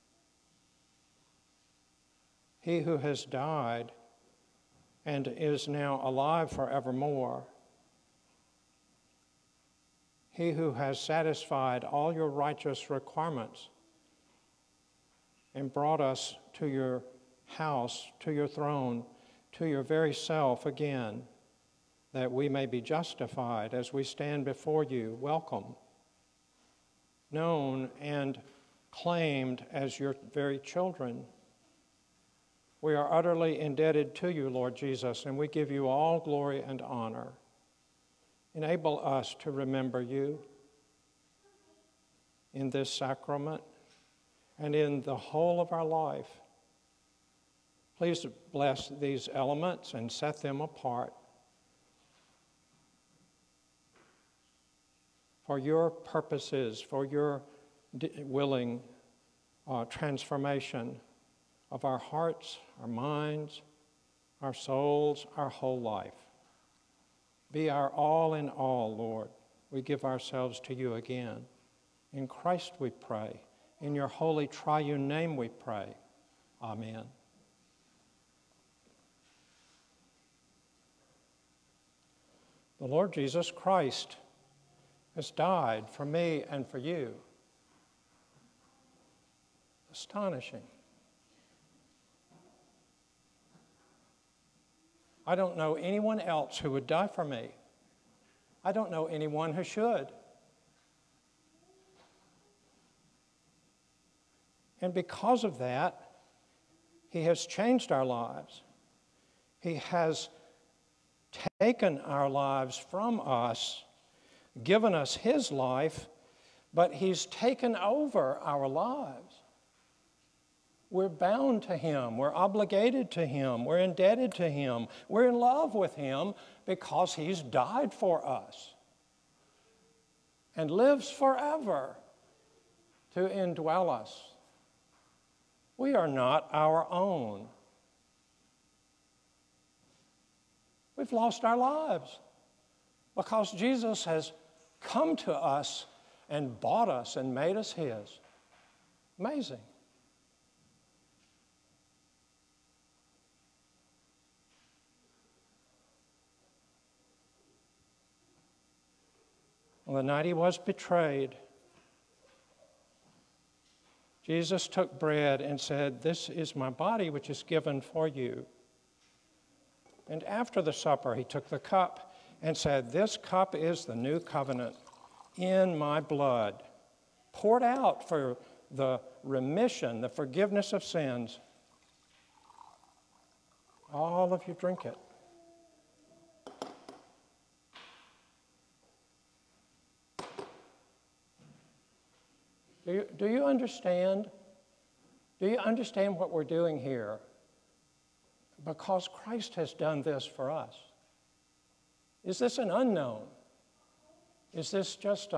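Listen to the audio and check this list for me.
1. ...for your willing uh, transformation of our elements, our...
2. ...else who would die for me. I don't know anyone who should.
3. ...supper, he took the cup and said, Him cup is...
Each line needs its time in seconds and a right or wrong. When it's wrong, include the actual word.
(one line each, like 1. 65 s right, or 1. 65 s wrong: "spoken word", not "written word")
1. 56 s wrong: "hearts", not "elements"
2. 96 s right
3. 170 s wrong: "This", not "Him".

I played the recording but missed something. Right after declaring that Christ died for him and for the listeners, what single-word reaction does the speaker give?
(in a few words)
Astonishing.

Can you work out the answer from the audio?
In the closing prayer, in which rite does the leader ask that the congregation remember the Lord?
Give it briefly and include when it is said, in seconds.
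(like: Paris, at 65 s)
sacrament, at 42 s.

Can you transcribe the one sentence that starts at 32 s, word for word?
We are utterly indebted to you, Lord Jesus, and we give you all glory and honor.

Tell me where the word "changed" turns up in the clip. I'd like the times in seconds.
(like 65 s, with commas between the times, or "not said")
107 s.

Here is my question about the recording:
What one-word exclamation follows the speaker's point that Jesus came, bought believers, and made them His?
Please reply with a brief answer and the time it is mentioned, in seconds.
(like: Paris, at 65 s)
Amazing, at 149 s.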